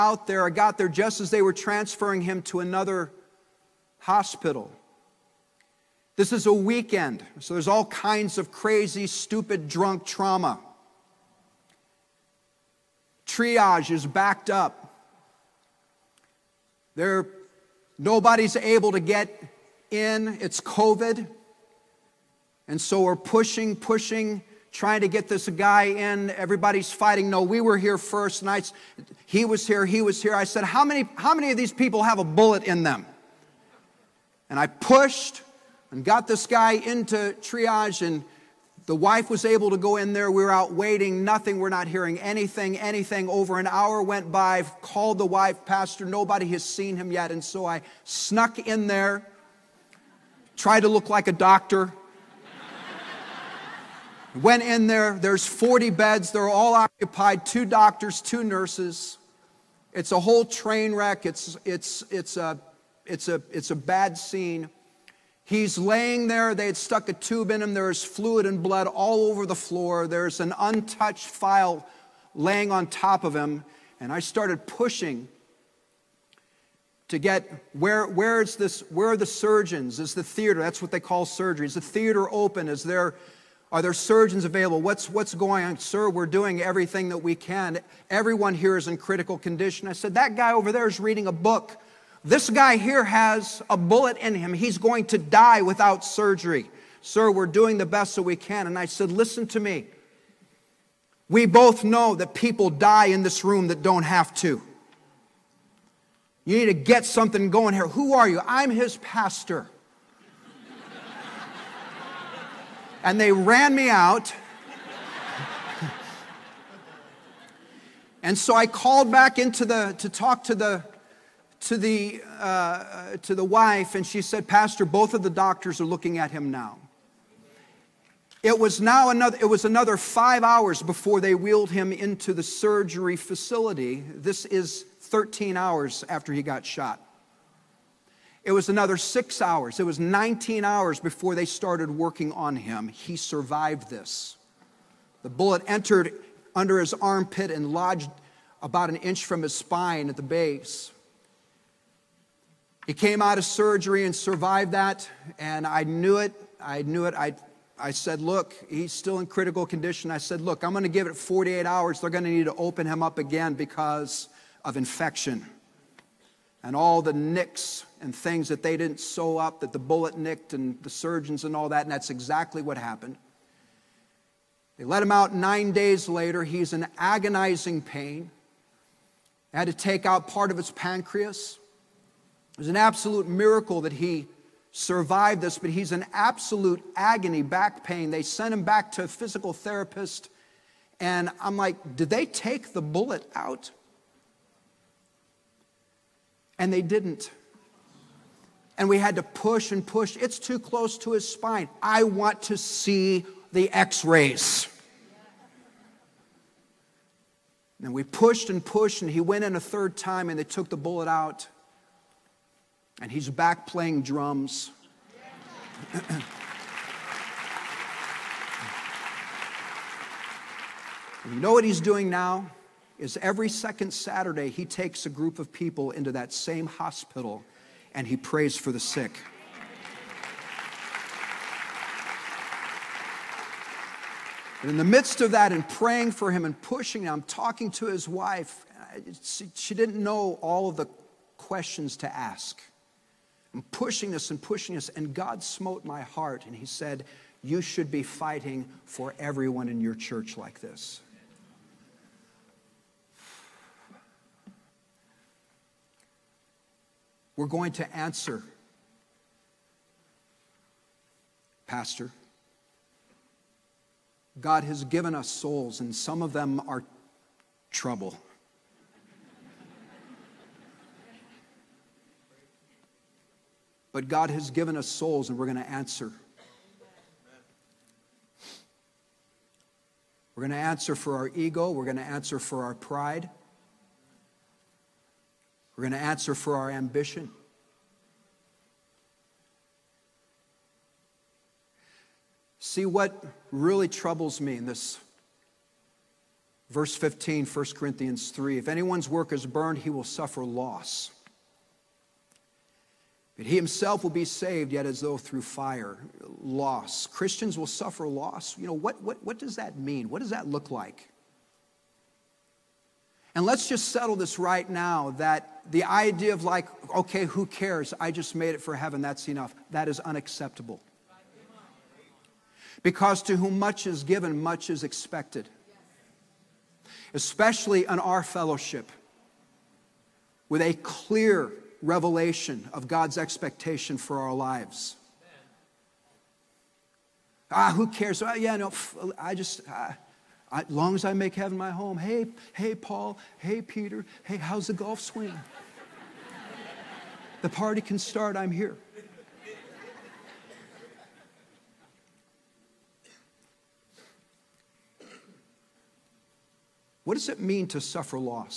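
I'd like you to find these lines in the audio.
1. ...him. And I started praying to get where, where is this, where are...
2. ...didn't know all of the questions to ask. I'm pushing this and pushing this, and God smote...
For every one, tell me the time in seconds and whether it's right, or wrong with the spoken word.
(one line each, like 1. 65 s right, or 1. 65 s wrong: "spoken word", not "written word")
1. 73 s wrong: "pushing", not "praying"
2. 239 s right.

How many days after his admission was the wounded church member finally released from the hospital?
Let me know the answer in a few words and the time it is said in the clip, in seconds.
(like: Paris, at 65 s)
nine, at 175 s.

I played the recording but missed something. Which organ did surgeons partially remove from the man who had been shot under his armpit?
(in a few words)
pancreas.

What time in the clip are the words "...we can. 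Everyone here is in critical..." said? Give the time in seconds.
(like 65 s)
87 s.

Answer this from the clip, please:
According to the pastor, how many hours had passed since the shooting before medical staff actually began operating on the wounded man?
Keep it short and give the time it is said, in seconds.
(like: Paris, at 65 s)
19, at 139 s.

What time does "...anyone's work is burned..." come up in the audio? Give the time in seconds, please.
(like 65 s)
298 s.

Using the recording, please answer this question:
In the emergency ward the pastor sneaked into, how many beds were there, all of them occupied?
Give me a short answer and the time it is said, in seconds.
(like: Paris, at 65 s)
40, at 55 s.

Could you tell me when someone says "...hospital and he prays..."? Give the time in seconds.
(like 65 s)
226 s.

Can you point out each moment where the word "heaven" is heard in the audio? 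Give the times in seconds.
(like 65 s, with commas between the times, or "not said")
318 s, 341 s.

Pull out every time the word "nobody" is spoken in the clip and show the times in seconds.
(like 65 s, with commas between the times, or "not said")
17 s, 46 s.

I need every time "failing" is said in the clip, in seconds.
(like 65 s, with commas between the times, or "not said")
not said.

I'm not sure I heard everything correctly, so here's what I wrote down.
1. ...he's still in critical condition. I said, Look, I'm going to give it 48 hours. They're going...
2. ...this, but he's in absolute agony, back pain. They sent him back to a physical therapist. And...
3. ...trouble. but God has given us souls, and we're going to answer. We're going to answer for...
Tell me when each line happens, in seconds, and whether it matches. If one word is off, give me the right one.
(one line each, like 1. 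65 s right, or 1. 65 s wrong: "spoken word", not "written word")
1. 158 s right
2. 185 s right
3. 267 s right.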